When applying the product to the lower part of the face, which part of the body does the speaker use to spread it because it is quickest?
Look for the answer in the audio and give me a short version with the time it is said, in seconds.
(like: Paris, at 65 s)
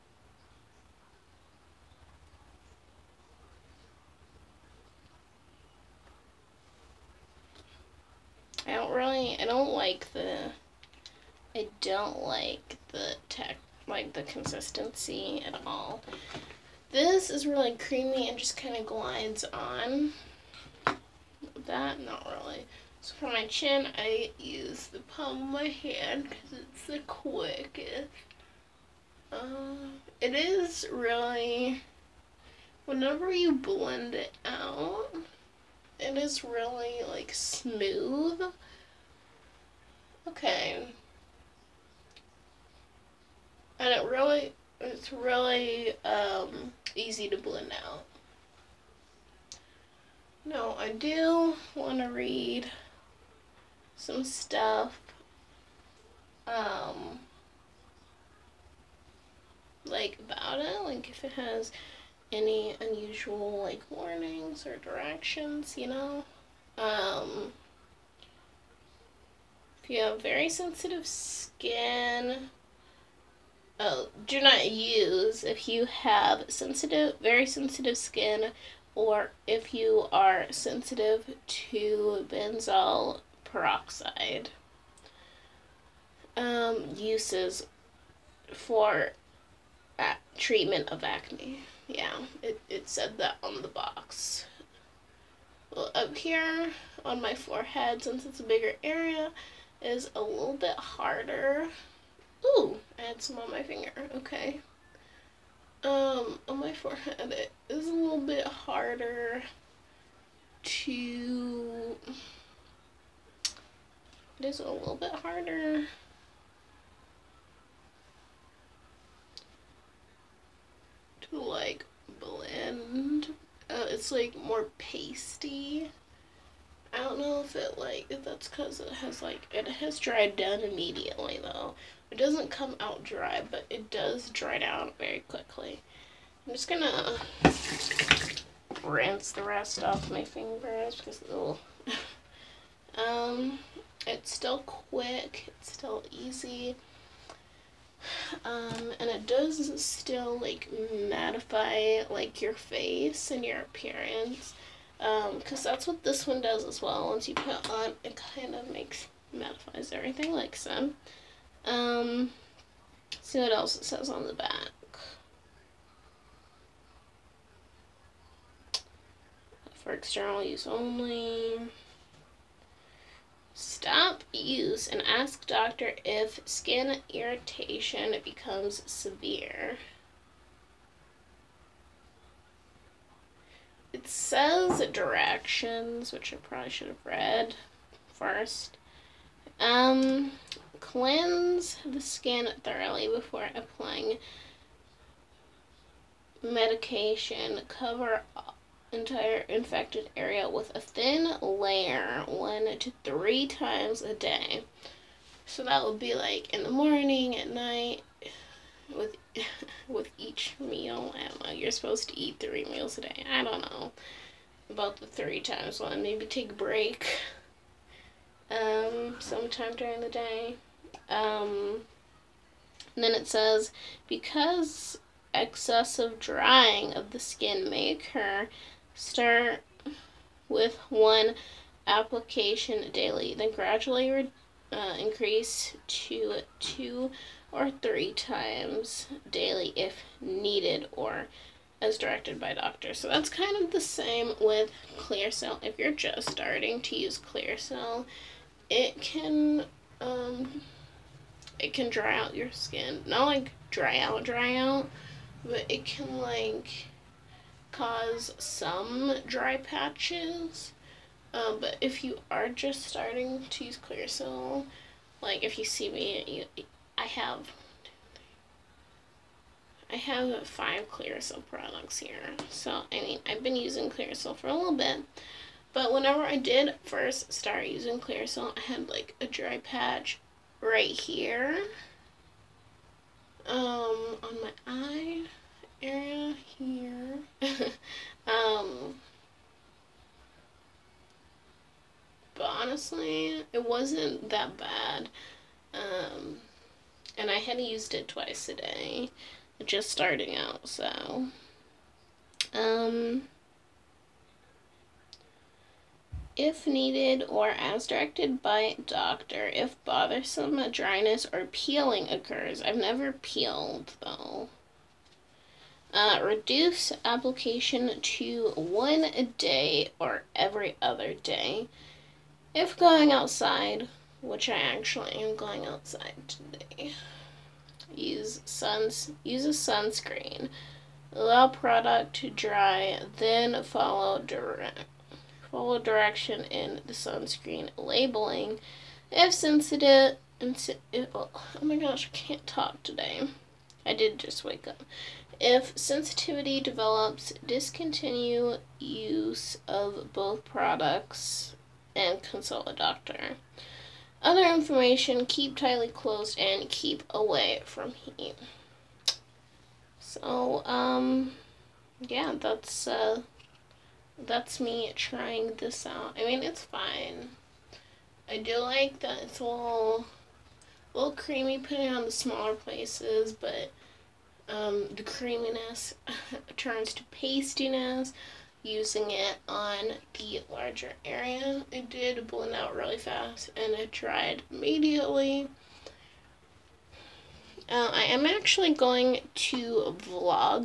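palm of my hand, at 24 s.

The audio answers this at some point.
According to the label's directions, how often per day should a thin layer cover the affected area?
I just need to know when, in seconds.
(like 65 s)
202 s.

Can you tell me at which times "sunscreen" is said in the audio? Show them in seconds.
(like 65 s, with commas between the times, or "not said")
329 s, 336 s.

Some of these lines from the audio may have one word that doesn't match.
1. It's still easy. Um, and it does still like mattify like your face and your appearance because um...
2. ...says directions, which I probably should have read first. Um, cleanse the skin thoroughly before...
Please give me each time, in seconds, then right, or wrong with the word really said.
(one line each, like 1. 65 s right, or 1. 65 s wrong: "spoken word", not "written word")
1. 145 s right
2. 184 s right.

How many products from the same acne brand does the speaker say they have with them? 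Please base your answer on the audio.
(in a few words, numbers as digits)
5.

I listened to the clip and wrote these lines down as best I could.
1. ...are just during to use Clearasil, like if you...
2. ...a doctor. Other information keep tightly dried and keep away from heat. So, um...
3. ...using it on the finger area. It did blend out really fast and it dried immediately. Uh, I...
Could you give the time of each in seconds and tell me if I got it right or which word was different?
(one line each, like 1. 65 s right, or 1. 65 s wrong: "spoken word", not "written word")
1. 262 s wrong: "starting", not "during"
2. 352 s wrong: "closed", not "dried"
3. 378 s wrong: "larger", not "finger".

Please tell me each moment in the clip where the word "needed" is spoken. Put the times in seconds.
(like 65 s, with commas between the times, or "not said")
240 s, 306 s.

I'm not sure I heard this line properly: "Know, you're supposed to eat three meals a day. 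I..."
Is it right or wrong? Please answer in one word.
right.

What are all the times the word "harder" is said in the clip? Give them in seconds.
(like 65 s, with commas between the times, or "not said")
100 s, 108 s, 115 s.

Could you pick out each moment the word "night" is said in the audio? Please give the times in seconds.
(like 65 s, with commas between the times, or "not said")
207 s.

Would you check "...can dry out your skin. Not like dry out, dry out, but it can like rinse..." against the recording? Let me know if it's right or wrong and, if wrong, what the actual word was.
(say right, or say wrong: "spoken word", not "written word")
wrong: "cause", not "rinse".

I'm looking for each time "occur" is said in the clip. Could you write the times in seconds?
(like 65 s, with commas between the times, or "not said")
227 s, 312 s.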